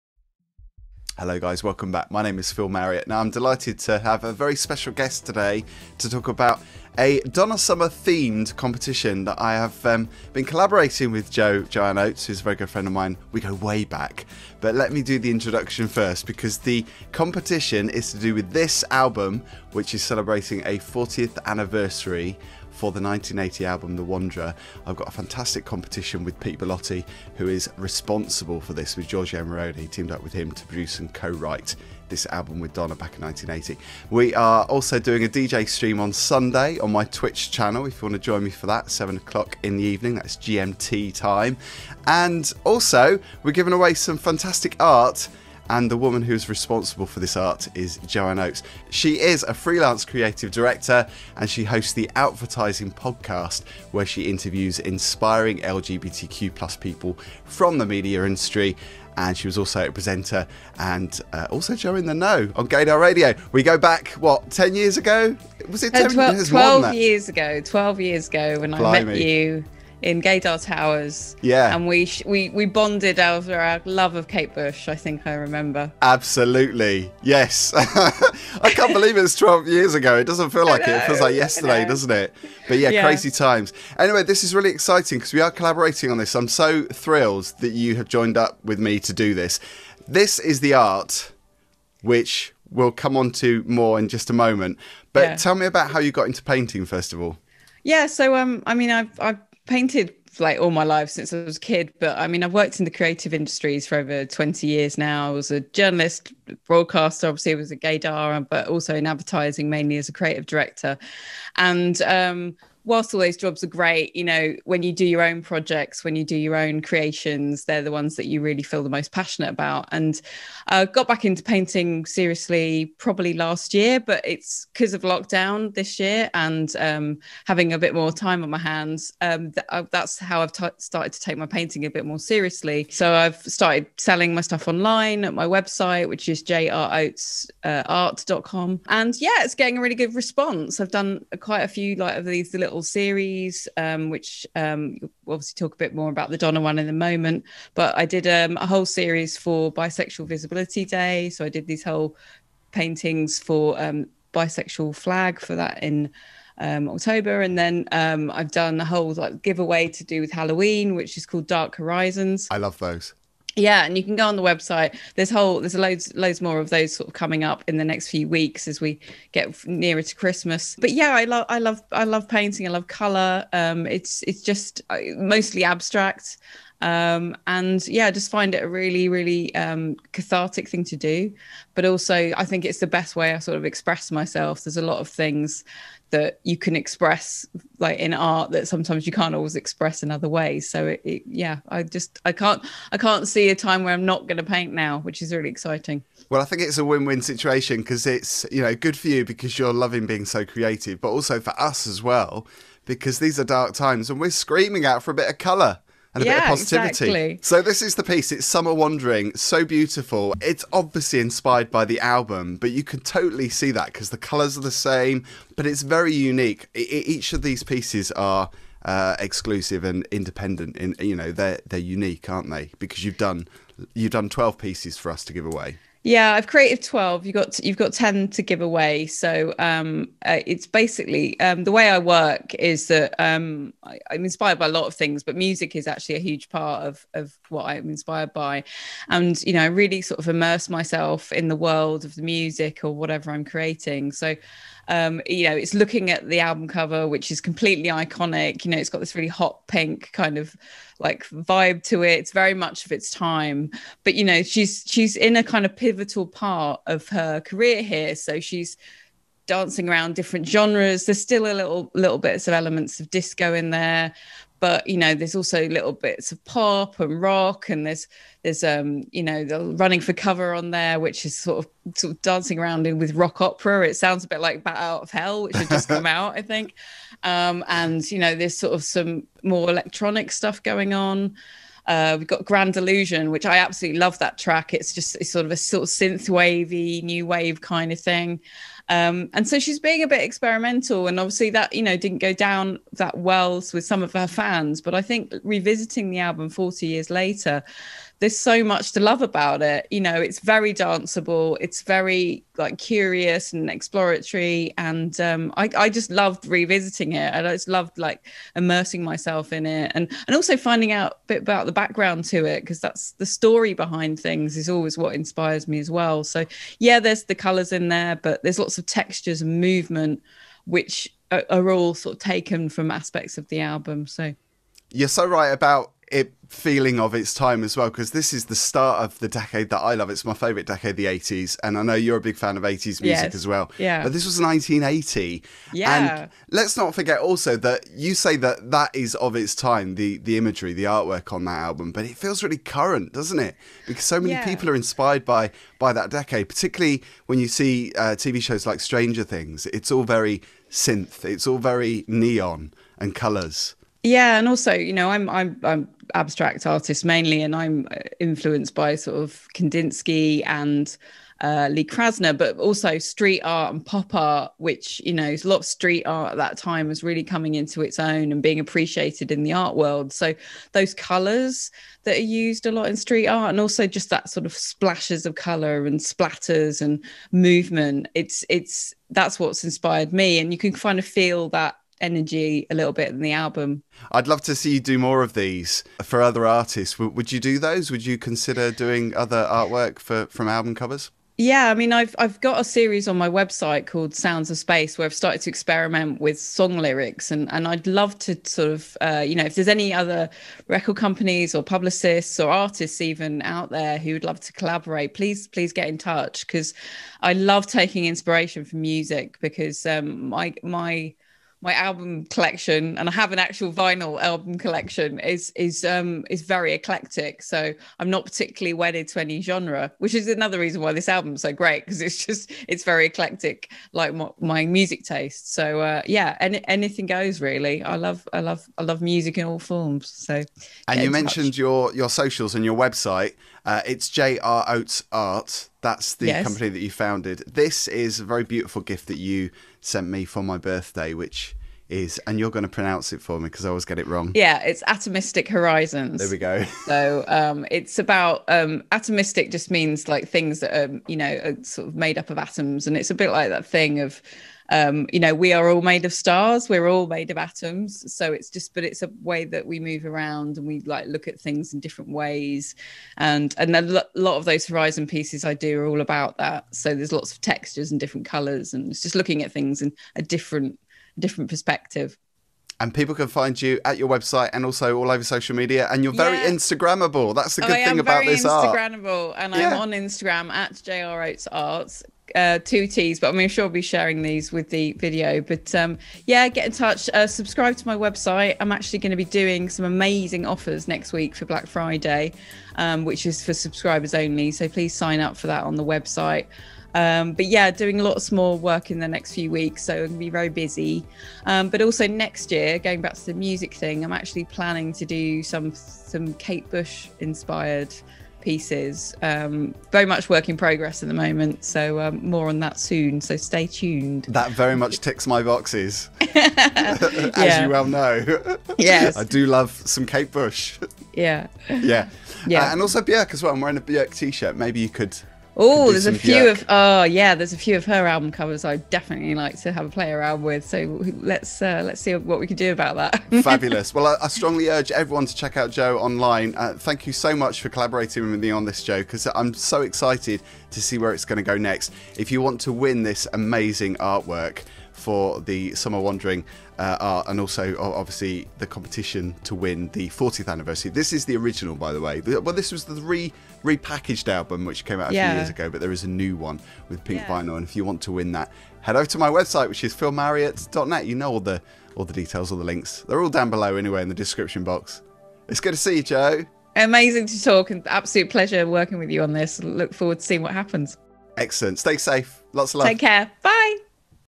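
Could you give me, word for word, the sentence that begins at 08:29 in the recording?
Um, very much work in progress at the moment, so um, more on that soon.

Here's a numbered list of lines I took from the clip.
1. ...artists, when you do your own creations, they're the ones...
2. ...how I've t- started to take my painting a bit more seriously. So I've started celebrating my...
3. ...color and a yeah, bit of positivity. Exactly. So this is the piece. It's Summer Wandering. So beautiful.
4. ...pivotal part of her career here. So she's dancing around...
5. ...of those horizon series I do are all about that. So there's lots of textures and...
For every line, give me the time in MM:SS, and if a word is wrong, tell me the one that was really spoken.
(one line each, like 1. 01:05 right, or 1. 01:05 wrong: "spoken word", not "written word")
1. 01:55 wrong: "projects", not "artists"
2. 02:10 wrong: "selling", not "celebrating"
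3. 03:25 right
4. 04:15 right
5. 07:44 wrong: "pieces", not "series".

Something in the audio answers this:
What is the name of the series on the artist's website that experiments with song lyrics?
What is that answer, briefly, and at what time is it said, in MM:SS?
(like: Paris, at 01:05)
Sounds of Space, at 06:34.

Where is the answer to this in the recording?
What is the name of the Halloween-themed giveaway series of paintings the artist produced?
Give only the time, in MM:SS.
02:41.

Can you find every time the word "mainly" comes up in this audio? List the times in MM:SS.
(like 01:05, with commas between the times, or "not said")
01:49, 05:57.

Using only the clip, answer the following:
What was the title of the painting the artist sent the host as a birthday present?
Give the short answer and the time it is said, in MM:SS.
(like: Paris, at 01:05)
Atomistic Horizons, at 07:24.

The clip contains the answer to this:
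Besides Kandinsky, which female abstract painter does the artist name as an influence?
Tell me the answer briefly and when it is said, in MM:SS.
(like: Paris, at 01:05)
Lee Krasner, at 06:01.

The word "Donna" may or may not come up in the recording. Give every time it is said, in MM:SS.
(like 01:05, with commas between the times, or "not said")
00:07, 00:32, 02:26.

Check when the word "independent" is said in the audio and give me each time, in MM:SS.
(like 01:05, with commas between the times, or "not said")
03:40.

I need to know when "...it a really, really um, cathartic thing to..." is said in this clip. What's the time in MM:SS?
02:58.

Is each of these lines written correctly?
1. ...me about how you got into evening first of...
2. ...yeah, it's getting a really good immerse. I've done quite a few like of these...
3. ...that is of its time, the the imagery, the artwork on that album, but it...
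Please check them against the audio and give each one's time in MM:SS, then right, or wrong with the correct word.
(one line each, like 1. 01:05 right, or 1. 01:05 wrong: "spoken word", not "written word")
1. 01:35 wrong: "painting", not "evening"
2. 02:19 wrong: "response", not "immerse"
3. 05:38 right.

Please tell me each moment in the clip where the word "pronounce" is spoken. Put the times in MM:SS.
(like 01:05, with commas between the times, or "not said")
07:22.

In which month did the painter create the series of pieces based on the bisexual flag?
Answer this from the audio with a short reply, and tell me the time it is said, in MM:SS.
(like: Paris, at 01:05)
October, at 02:36.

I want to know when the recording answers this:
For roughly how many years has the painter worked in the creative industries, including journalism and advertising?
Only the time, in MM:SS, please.
01:43.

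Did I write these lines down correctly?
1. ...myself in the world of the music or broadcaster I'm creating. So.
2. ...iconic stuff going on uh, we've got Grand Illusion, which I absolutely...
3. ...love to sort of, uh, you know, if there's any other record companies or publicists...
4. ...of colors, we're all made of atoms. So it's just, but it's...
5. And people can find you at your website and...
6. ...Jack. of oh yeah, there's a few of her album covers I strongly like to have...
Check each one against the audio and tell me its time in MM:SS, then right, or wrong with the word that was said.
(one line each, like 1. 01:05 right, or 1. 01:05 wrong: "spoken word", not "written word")
1. 04:00 wrong: "whatever", not "broadcaster"
2. 04:39 wrong: "electronic", not "iconic"
3. 06:37 right
4. 07:36 wrong: "stars", not "colors"
5. 07:52 right
6. 08:46 wrong: "definitely", not "strongly".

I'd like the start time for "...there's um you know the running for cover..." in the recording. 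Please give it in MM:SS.
04:28.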